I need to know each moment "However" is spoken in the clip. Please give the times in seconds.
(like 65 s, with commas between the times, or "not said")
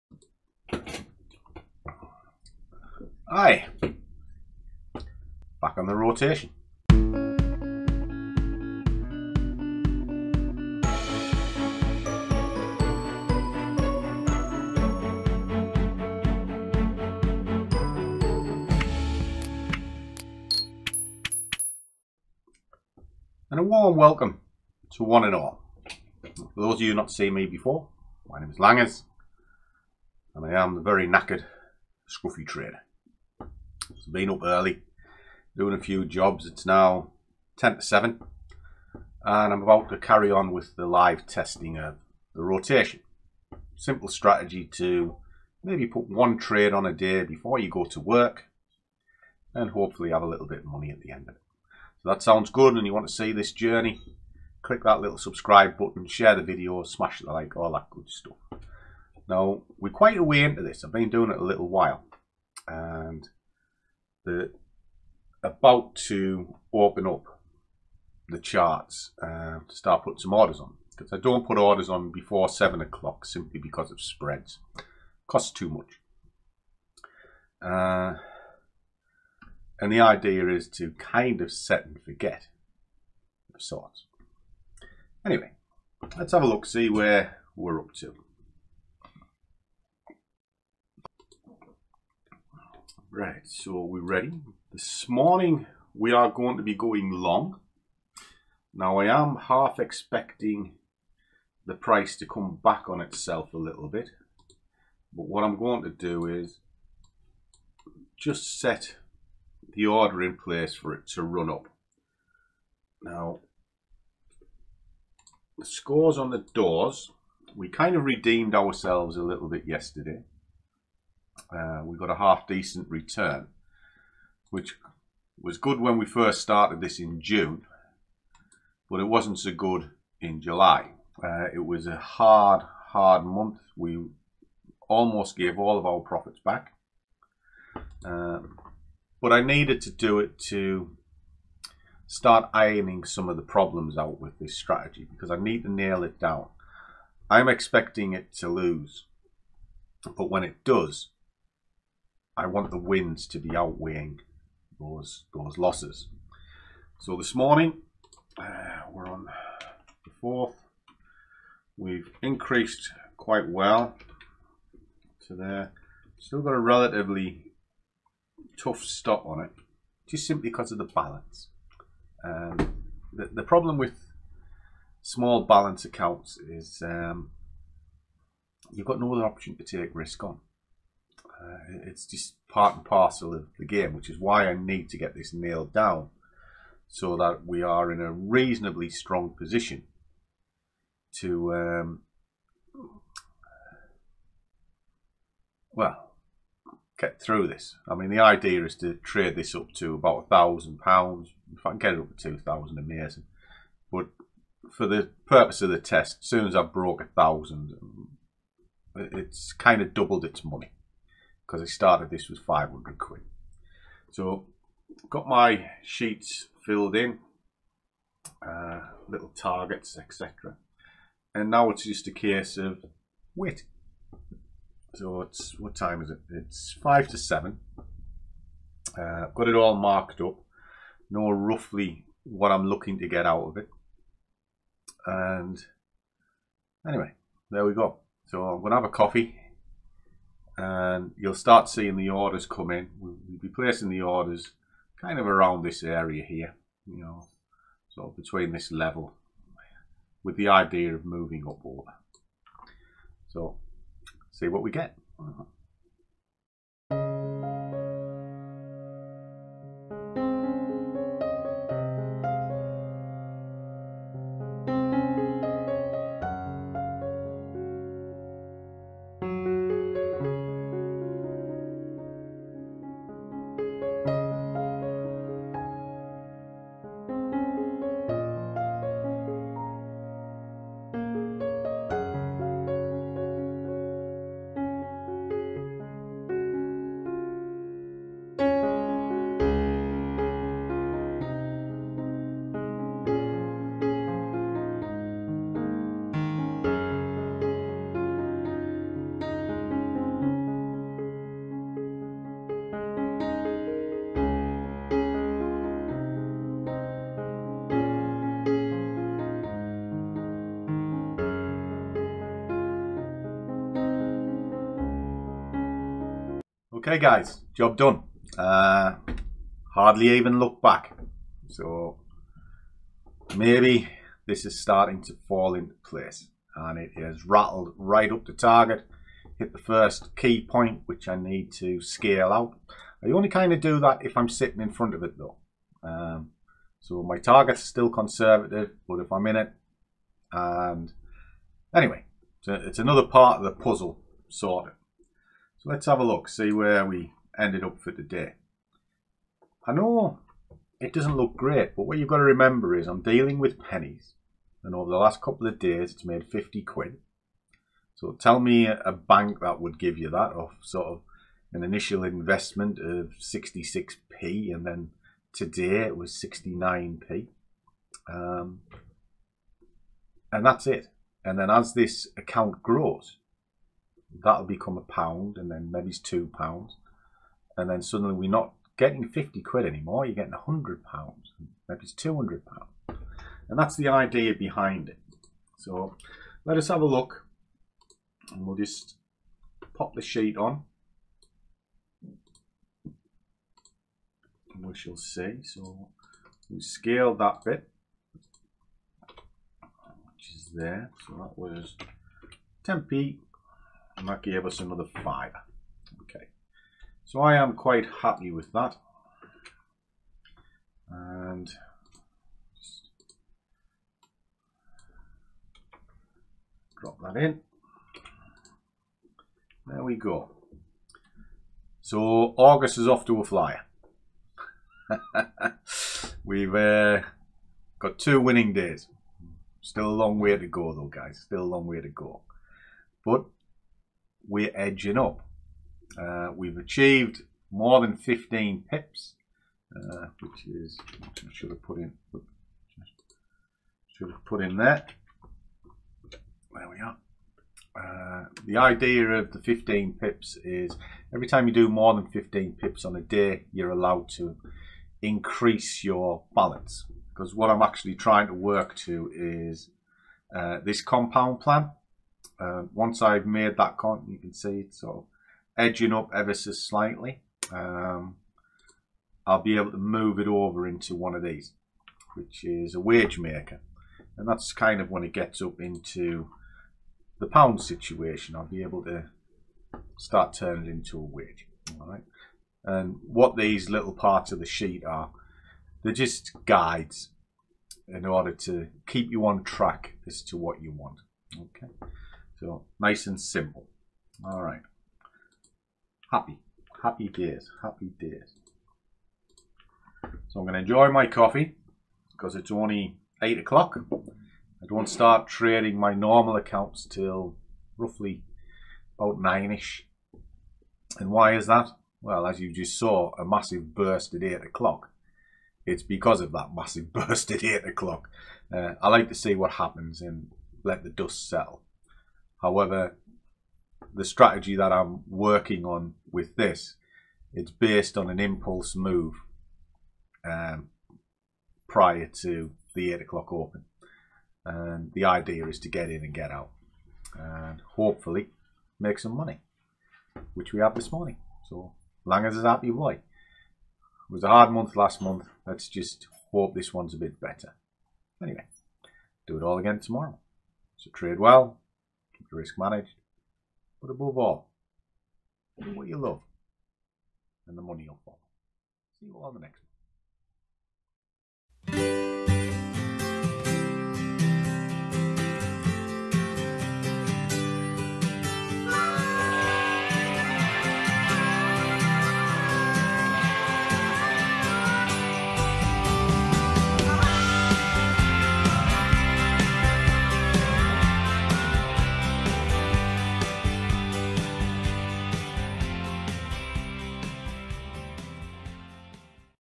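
522 s.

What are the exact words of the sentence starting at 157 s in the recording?
So this morning uh, we're on the fourth.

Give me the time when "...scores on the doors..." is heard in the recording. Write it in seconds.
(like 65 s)
115 s.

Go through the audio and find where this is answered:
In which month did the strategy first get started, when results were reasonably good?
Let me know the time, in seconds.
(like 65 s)
127 s.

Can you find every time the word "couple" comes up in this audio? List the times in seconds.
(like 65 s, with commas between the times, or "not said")
355 s.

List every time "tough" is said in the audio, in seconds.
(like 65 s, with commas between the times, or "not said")
168 s.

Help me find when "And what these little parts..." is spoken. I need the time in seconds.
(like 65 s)
482 s.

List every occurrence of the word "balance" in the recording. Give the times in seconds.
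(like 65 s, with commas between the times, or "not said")
170 s, 175 s, 456 s.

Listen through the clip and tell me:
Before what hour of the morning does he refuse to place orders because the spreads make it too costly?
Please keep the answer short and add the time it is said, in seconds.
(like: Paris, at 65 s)
7 o'clock, at 72 s.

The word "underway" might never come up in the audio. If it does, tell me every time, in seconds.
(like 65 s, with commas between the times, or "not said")
not said.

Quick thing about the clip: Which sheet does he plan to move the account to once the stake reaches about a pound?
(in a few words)
wage maker.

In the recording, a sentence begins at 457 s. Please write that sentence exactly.
Because what I'm actually trying to work to is uh, this compound plan.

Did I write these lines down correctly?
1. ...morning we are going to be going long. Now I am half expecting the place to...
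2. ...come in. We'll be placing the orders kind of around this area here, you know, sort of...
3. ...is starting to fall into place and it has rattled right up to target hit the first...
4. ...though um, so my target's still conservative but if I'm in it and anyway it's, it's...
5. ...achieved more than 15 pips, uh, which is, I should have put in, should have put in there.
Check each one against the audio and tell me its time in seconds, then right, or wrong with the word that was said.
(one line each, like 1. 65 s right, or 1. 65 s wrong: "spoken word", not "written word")
1. 95 s wrong: "price", not "place"
2. 242 s right
3. 324 s right
4. 335 s right
5. 436 s right.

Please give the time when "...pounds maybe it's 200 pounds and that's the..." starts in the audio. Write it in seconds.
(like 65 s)
380 s.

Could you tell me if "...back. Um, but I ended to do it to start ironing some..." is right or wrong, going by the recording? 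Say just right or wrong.
wrong.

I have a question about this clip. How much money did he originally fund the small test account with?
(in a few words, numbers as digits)
500 pounds.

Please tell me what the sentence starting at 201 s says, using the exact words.
If I can get it up to two thousand, amazing.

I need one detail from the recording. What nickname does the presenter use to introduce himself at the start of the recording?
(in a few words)
Langers.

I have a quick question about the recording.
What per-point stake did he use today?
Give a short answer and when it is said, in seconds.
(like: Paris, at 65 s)
69p, at 366 s.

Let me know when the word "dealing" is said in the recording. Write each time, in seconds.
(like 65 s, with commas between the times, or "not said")
353 s.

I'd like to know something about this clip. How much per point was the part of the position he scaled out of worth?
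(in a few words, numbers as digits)
10p.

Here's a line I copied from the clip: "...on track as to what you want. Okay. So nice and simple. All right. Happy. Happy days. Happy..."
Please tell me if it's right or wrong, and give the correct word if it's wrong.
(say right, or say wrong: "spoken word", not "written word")
right.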